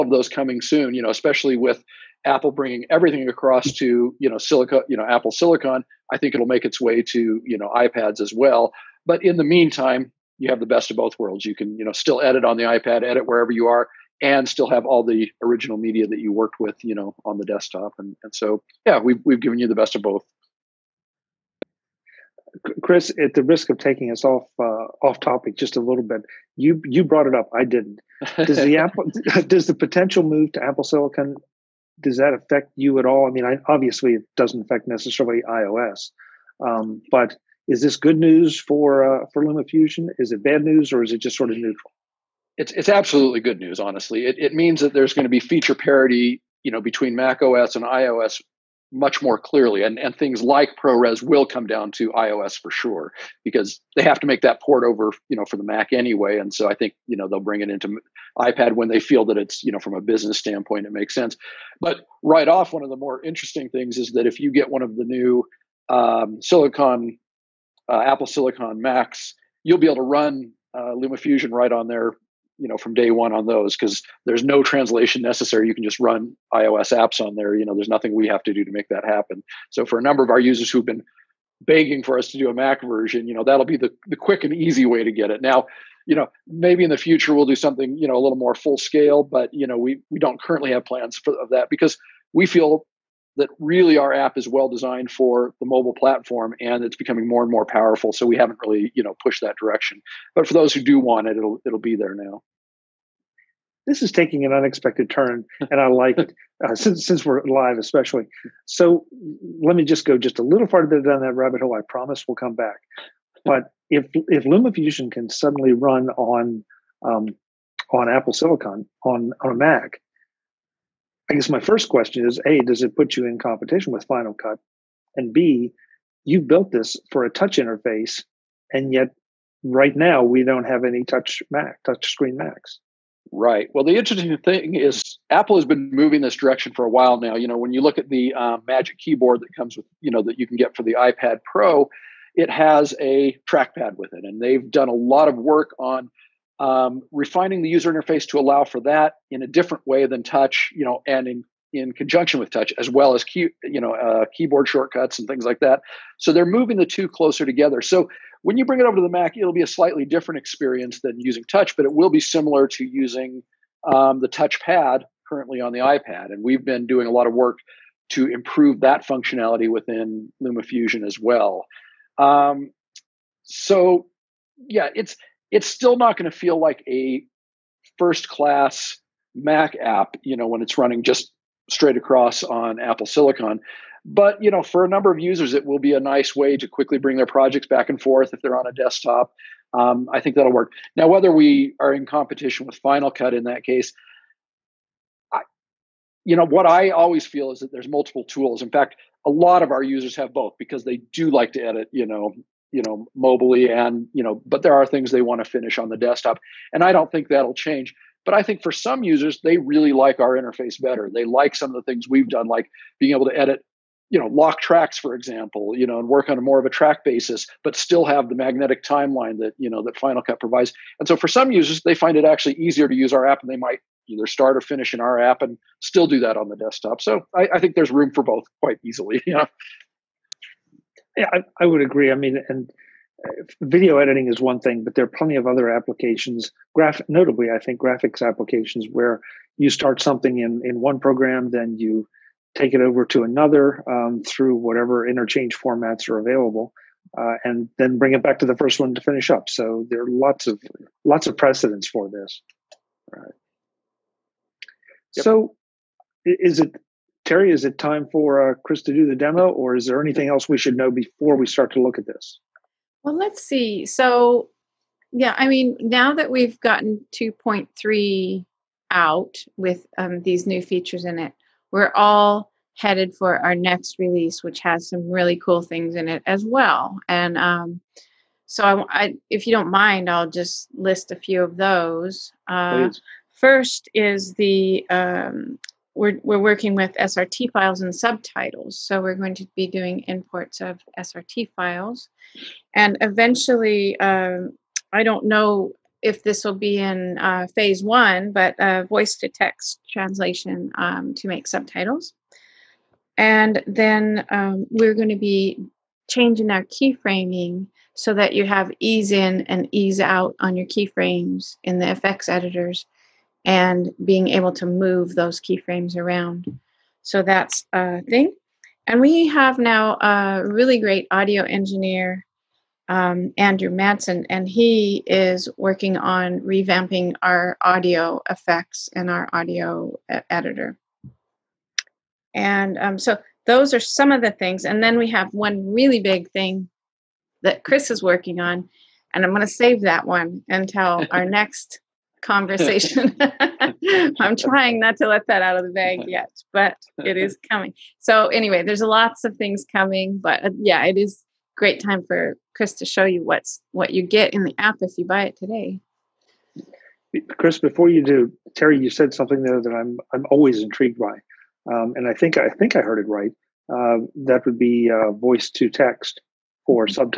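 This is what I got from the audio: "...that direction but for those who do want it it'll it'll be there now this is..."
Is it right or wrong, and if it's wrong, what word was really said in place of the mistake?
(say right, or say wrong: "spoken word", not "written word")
right.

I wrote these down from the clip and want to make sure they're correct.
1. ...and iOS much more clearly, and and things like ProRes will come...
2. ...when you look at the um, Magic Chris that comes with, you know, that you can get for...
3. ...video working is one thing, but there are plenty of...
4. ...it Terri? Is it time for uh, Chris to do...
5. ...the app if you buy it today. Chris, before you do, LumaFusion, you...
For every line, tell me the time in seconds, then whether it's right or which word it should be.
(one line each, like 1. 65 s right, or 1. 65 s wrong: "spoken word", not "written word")
1. 47 s right
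2. 137 s wrong: "Keyboard", not "Chris"
3. 233 s wrong: "editing", not "working"
4. 256 s right
5. 354 s wrong: "Terri", not "LumaFusion".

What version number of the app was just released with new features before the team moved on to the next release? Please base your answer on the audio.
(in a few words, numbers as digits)
2.3.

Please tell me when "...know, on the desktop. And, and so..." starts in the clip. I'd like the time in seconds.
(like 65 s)
16 s.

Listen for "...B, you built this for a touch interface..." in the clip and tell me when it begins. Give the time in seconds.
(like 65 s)
125 s.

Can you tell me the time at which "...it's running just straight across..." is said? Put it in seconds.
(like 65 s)
180 s.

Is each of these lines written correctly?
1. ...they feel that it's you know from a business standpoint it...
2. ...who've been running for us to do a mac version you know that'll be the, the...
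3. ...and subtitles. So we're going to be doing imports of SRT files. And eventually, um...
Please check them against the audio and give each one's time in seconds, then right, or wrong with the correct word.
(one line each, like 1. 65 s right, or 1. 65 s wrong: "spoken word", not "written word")
1. 58 s right
2. 80 s wrong: "begging", not "running"
3. 287 s right.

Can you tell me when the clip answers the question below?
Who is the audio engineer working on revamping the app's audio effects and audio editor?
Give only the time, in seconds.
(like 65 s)
323 s.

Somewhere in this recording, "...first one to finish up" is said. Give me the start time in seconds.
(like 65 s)
248 s.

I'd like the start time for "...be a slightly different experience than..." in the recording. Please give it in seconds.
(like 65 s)
159 s.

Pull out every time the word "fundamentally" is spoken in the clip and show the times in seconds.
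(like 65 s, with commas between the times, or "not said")
not said.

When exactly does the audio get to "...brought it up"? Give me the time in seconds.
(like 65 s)
27 s.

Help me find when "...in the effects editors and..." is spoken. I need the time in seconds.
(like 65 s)
311 s.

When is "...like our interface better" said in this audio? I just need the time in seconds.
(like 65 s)
209 s.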